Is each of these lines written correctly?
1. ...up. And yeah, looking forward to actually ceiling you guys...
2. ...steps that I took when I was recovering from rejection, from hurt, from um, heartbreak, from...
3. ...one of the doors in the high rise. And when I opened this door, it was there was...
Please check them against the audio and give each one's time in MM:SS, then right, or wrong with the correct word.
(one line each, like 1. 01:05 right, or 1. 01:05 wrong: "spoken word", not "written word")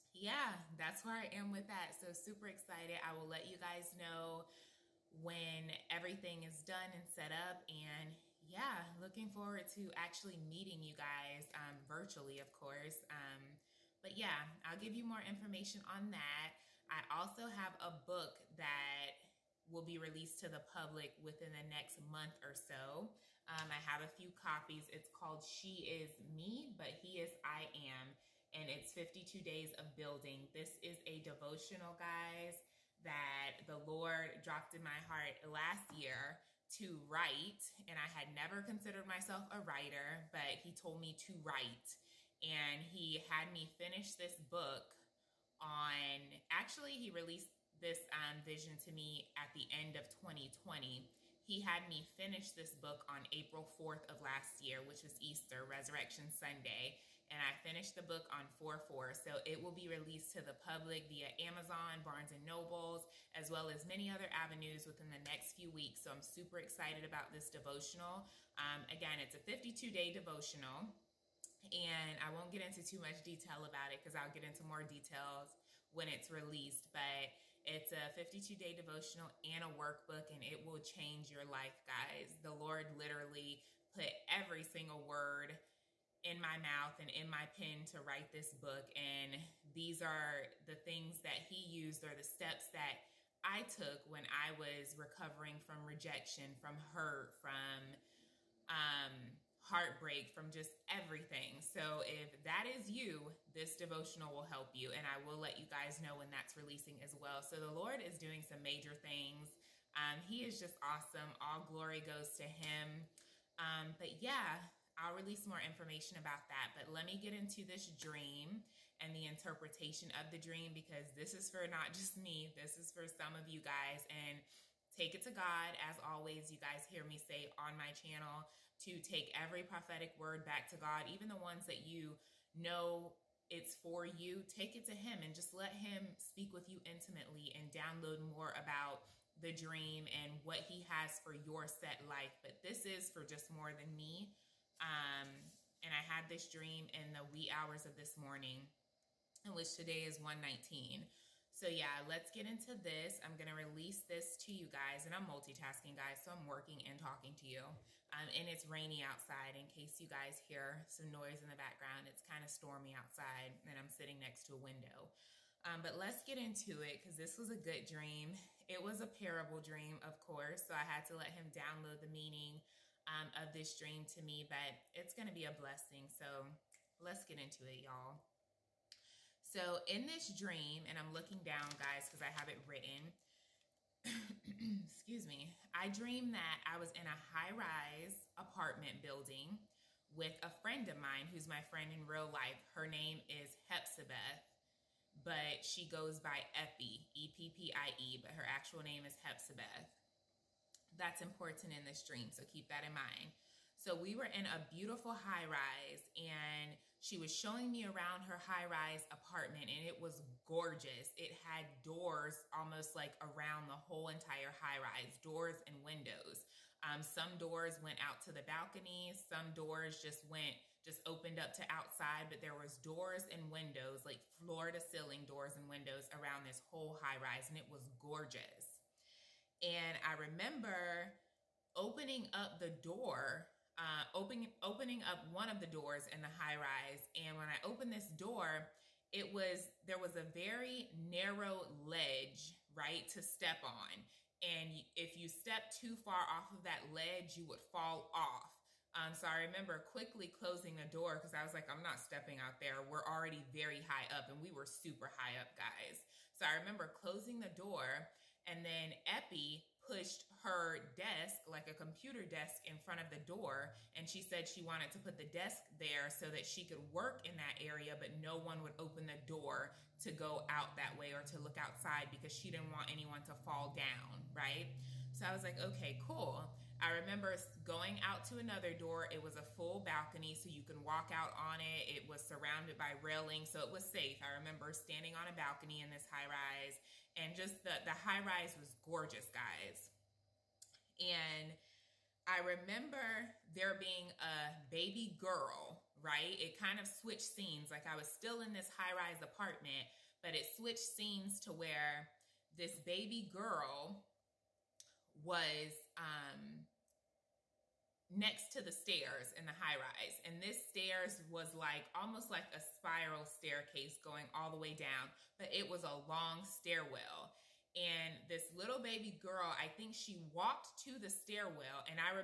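1. 00:07 wrong: "meeting", not "ceiling"
2. 01:32 right
3. 03:55 right.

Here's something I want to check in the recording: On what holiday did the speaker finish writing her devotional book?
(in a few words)
Easter.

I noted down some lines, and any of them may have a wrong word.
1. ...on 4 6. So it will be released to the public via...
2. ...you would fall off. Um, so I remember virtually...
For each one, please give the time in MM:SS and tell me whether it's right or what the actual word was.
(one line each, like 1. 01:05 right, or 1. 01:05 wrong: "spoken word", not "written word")
1. 00:58 wrong: "4", not "6"
2. 04:07 wrong: "quickly", not "virtually".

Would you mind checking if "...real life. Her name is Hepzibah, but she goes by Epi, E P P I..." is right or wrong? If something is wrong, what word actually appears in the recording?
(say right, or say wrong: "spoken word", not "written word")
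right.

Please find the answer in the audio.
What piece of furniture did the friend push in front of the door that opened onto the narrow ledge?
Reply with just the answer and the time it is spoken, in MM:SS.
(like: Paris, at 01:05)
computer desk, at 04:21.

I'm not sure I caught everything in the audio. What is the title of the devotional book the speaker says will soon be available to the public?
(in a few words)
She Is Me, but He Is I Am.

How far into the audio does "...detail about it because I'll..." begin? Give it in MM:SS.
01:13.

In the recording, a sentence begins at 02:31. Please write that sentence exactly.
So yeah, let's get into this.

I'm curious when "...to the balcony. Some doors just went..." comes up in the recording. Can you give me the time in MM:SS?
03:38.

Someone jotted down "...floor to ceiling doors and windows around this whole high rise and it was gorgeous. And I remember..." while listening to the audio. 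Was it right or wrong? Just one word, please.
right.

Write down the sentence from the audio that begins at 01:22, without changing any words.
The Lord literally put every single word in my mouth and in my pen to write this book.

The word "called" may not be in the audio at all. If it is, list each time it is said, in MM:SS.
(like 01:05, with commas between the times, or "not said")
00:25.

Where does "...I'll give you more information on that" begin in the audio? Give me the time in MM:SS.
00:14.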